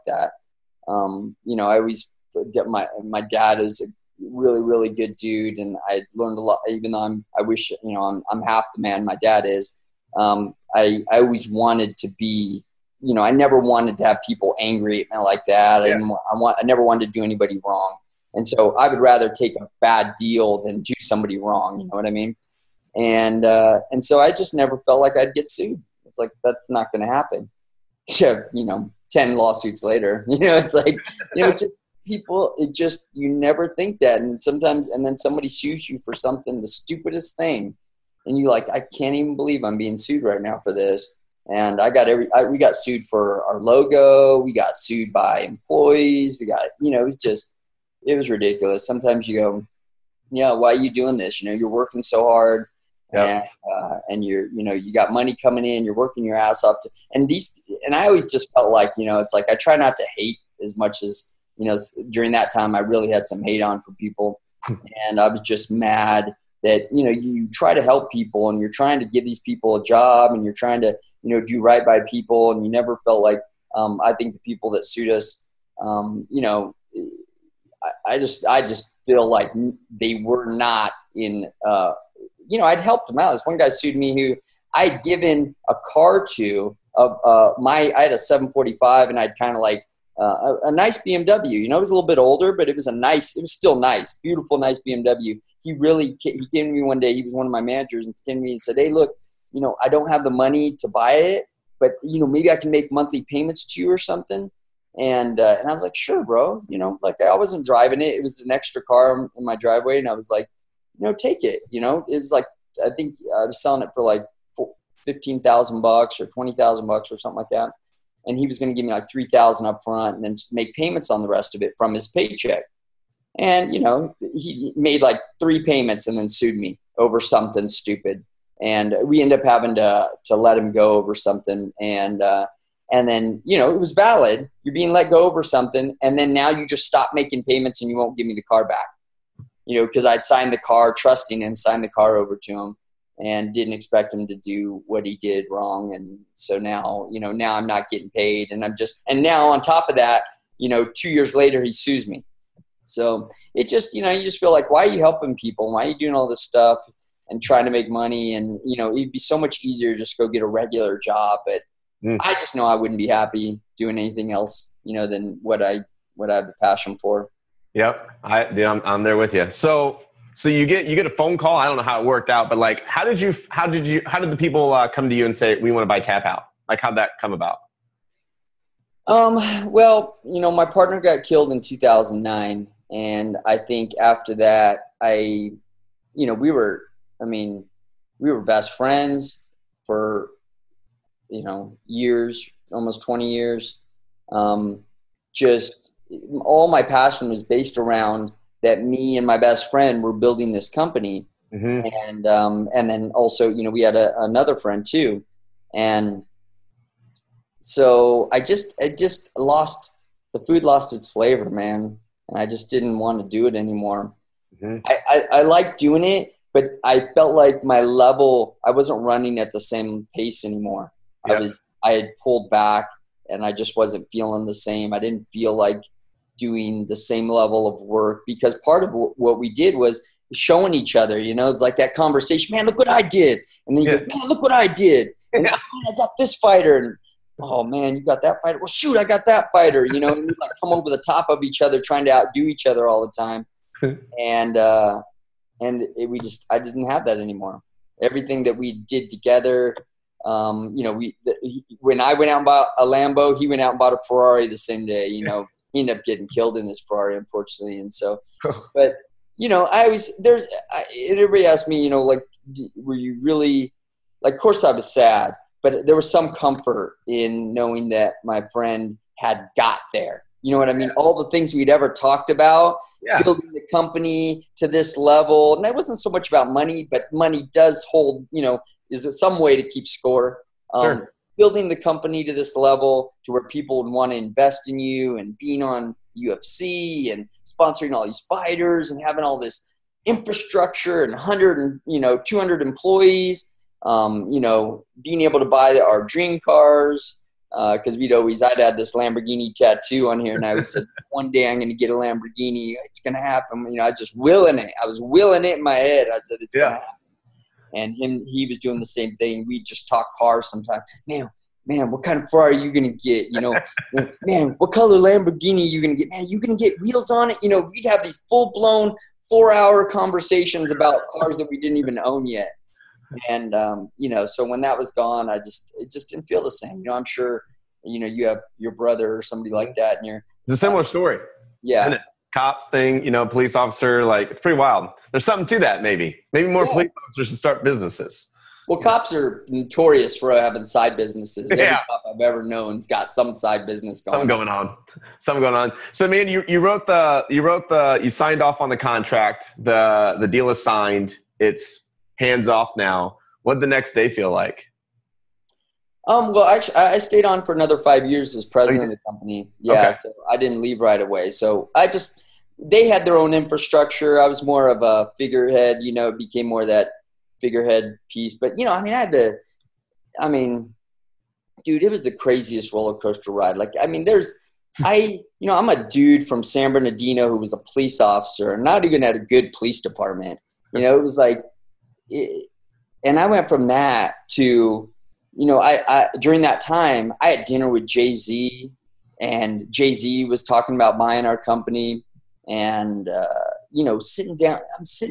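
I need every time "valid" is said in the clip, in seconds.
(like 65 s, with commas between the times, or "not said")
133 s.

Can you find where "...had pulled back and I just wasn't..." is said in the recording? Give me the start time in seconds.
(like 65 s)
221 s.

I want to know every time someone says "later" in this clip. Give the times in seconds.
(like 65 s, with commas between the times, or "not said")
29 s, 151 s.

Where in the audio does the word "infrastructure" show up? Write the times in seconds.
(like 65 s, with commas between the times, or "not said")
290 s, 363 s.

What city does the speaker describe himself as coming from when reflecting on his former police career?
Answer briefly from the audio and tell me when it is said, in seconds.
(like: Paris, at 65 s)
San Bernardino, at 376 s.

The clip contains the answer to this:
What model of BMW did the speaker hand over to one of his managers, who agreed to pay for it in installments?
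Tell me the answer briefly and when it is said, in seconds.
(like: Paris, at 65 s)
745, at 88 s.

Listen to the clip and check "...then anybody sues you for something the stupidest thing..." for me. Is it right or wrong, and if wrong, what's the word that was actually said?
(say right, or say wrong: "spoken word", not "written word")
wrong: "somebody", not "anybody".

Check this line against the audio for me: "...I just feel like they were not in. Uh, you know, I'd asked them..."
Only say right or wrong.
wrong.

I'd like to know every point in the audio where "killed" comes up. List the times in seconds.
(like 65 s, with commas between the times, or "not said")
181 s, 256 s.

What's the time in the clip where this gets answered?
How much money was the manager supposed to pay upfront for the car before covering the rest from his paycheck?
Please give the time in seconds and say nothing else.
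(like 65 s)
119 s.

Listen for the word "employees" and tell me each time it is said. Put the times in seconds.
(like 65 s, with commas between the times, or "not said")
45 s, 292 s.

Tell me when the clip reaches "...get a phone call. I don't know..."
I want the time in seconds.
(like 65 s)
170 s.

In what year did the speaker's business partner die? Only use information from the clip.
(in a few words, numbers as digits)
2009.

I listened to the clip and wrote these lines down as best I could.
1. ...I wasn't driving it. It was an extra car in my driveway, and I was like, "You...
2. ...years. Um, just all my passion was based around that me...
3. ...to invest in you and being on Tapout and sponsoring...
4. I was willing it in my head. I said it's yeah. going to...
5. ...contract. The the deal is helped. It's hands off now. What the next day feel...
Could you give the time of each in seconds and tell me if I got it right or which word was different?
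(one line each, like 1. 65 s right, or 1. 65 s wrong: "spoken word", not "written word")
1. 107 s right
2. 193 s right
3. 284 s wrong: "UFC", not "Tapout"
4. 304 s right
5. 348 s wrong: "signed", not "helped".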